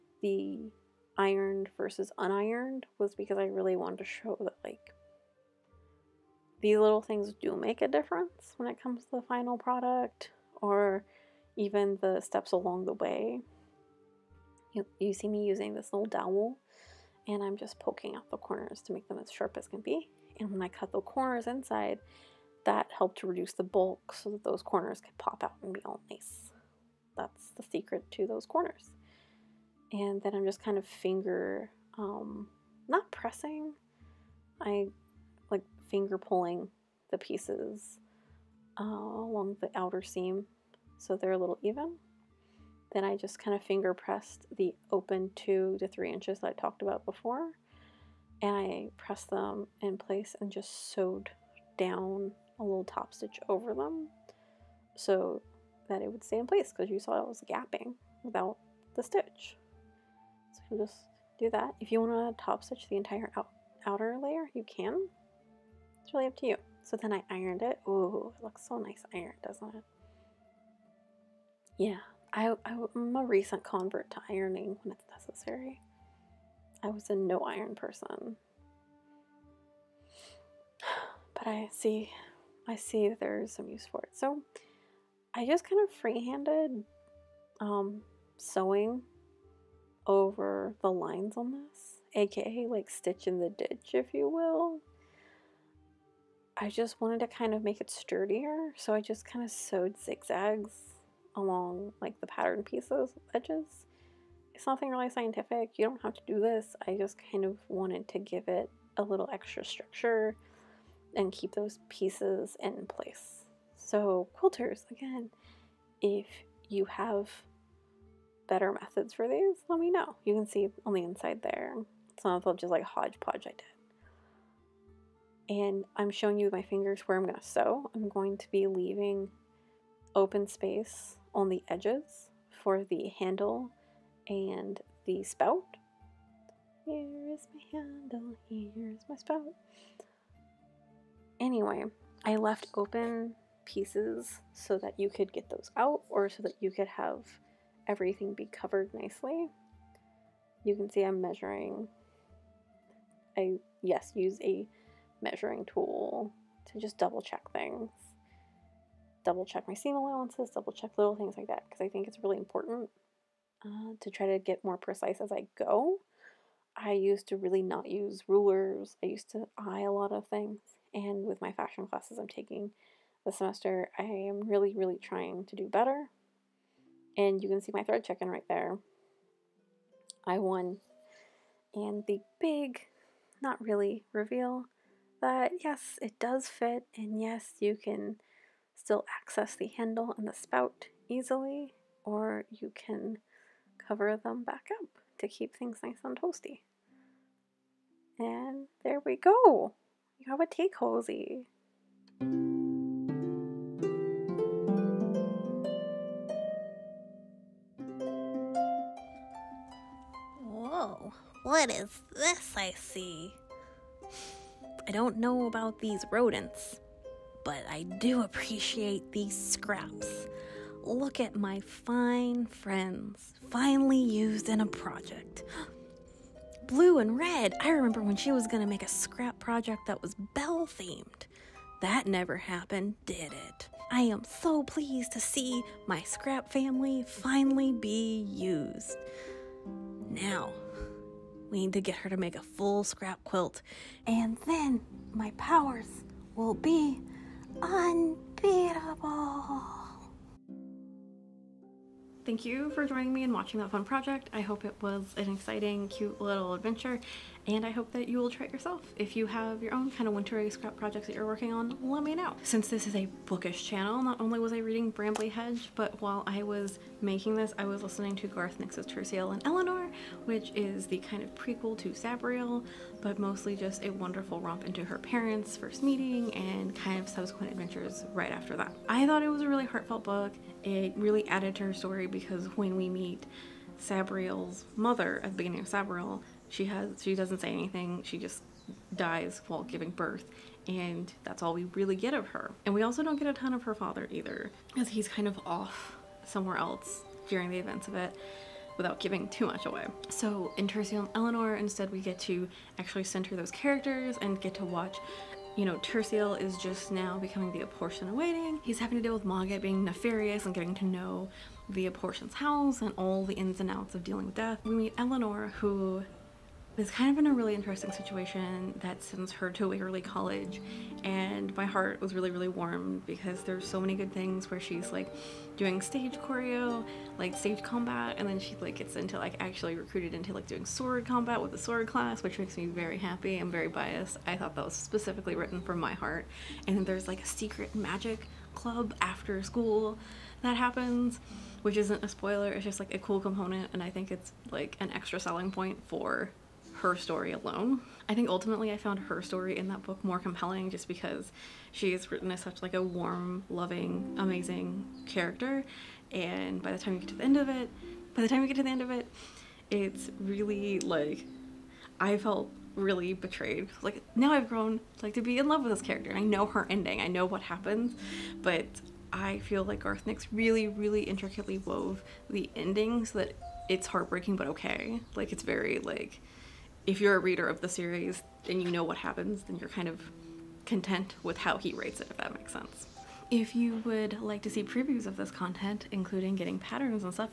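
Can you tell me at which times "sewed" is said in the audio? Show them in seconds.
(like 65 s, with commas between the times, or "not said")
50 s, 99 s.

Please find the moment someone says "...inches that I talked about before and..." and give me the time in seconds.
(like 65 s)
46 s.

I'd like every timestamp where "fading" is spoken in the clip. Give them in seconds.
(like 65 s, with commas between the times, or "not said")
not said.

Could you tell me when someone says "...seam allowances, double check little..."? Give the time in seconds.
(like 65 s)
159 s.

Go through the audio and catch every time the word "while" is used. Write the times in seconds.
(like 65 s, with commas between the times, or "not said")
265 s, 289 s.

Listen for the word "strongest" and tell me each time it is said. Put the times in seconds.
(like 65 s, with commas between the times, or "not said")
not said.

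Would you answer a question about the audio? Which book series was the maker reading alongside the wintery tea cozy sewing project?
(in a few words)
Brambly Hedge.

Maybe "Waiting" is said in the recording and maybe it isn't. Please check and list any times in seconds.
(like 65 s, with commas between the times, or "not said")
307 s.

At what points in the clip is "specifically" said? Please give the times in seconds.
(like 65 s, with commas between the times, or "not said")
334 s.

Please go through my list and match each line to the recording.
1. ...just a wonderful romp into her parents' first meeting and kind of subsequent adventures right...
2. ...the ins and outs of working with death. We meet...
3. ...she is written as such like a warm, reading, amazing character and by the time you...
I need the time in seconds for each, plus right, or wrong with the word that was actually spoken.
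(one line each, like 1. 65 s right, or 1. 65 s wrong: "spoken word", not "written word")
1. 273 s right
2. 313 s wrong: "dealing", not "working"
3. 351 s wrong: "loving", not "reading".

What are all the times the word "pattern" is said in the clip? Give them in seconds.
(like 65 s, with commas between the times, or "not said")
102 s, 386 s.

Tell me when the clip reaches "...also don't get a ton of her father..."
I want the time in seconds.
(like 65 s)
292 s.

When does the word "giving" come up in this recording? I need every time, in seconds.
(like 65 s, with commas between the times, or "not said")
289 s, 298 s.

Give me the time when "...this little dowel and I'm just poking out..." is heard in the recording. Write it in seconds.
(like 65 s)
15 s.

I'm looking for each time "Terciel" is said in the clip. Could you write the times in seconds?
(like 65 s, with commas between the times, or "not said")
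268 s, 300 s, 305 s.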